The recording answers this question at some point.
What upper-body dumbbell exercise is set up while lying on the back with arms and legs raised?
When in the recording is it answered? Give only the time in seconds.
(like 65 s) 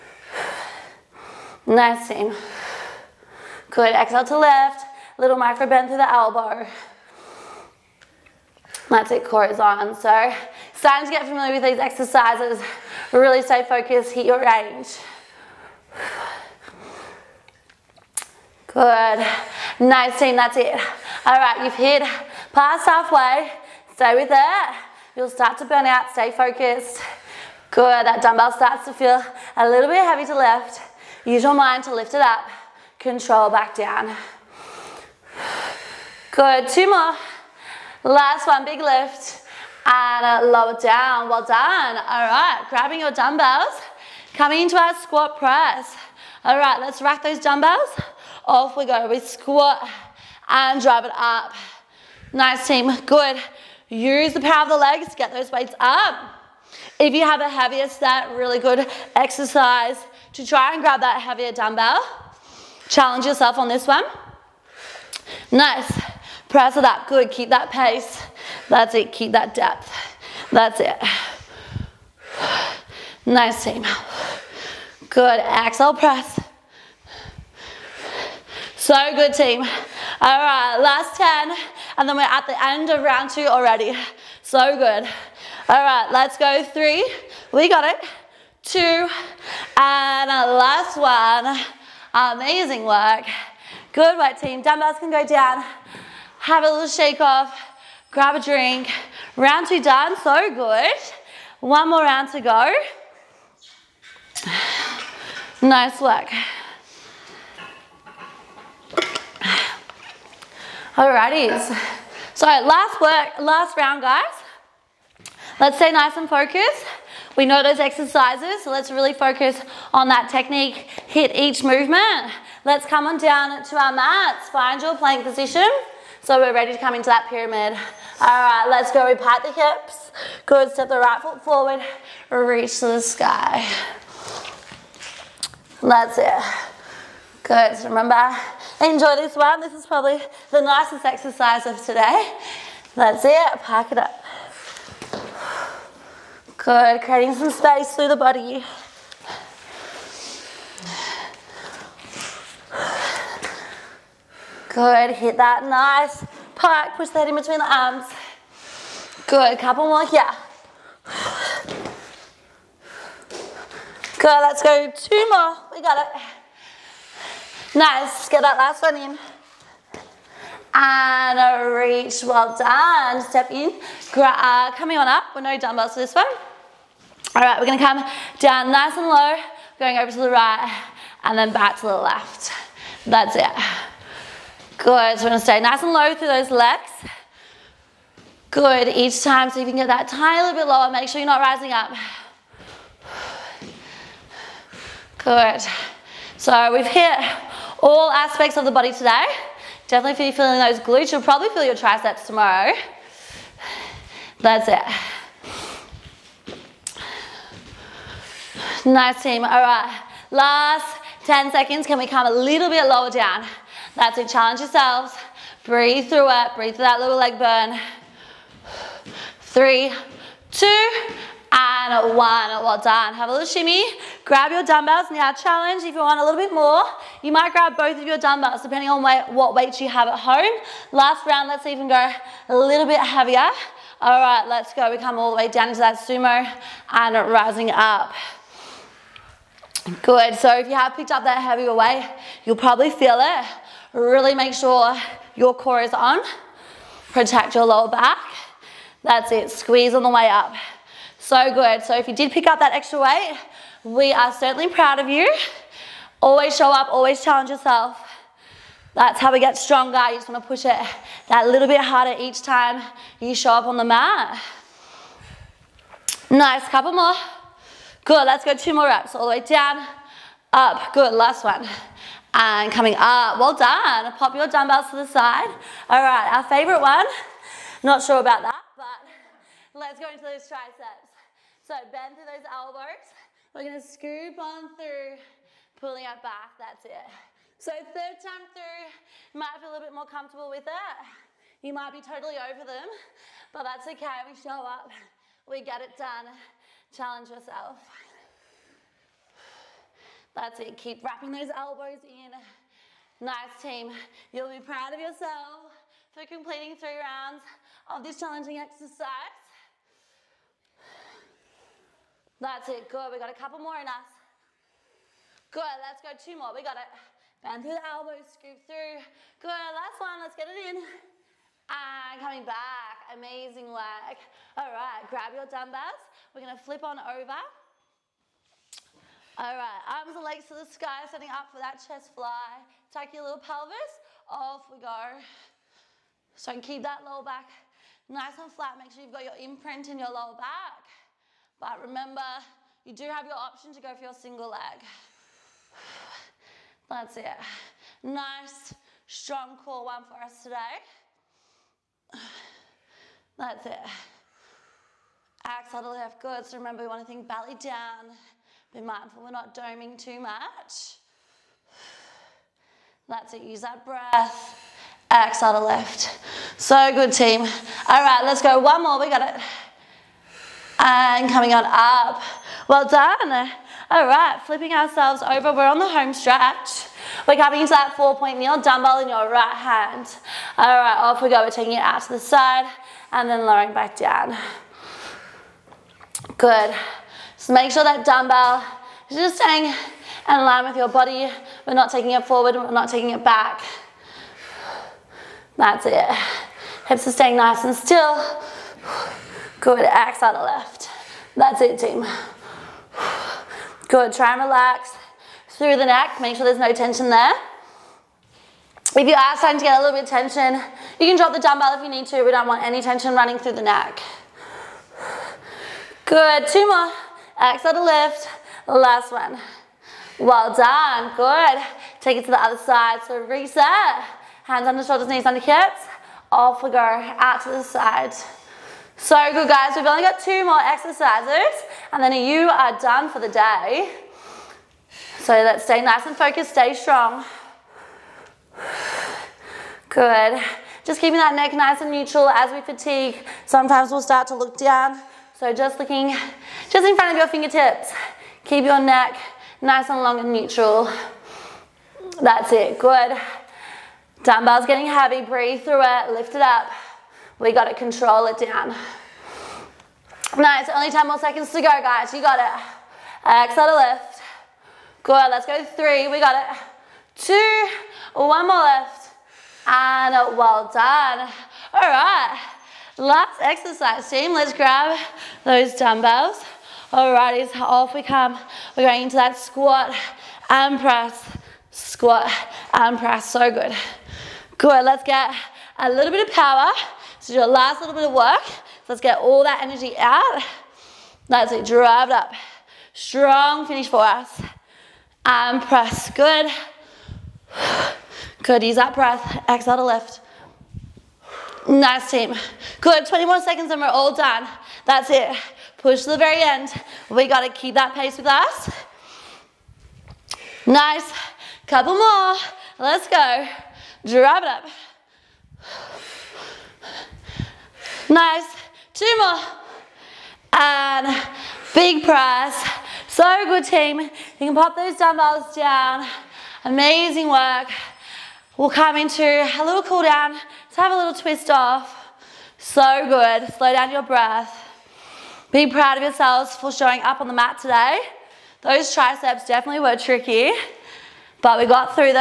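331 s.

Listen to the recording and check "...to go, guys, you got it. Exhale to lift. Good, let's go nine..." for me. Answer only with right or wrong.
wrong.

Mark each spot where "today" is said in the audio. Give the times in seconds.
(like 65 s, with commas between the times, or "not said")
141 s, 198 s, 350 s, 537 s.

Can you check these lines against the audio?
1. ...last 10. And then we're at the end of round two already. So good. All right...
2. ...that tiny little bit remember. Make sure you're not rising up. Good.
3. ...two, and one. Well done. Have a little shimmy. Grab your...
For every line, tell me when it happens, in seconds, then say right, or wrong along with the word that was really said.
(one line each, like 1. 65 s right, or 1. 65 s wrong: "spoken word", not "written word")
1. 80 s right
2. 189 s wrong: "lower", not "remember"
3. 220 s right.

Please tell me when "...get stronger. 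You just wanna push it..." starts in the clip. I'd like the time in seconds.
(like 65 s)
259 s.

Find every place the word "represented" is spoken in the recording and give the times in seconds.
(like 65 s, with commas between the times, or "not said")
not said.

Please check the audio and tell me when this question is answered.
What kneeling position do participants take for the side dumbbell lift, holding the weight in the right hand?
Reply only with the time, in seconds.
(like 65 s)
377 s.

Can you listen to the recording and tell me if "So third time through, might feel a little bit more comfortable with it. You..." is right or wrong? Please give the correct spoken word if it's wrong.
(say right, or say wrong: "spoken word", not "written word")
right.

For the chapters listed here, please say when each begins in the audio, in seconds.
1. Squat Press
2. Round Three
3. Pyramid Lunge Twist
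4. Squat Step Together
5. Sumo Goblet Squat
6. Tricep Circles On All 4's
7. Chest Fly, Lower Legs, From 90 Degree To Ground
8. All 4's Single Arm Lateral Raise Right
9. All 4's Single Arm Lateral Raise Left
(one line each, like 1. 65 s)
1. 47 s
2. 97 s
3. 126 s
4. 177 s
5. 227 s
6. 277 s
7. 327 s
8. 376 s
9. 426 s.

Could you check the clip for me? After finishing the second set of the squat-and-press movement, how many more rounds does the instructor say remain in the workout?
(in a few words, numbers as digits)
1.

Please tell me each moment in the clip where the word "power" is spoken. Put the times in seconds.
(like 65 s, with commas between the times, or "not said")
54 s, 486 s.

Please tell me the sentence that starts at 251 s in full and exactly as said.
So good, so if you did pick up that extra weight, we are certainly proud of you.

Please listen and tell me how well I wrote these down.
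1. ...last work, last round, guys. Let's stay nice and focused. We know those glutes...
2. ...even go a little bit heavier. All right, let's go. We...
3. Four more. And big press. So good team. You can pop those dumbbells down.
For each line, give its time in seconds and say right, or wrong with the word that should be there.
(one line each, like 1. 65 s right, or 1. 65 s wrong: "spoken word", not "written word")
1. 112 s wrong: "exercises", not "glutes"
2. 231 s right
3. 518 s wrong: "Two", not "Four".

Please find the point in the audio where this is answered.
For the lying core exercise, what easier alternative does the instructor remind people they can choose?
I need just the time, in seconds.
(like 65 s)
344 s.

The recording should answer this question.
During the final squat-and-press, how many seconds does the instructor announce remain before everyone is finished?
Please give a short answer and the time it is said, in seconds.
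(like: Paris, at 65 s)
20, at 503 s.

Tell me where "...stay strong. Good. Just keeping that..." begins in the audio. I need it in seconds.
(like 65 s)
436 s.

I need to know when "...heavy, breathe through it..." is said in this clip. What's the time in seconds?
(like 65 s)
454 s.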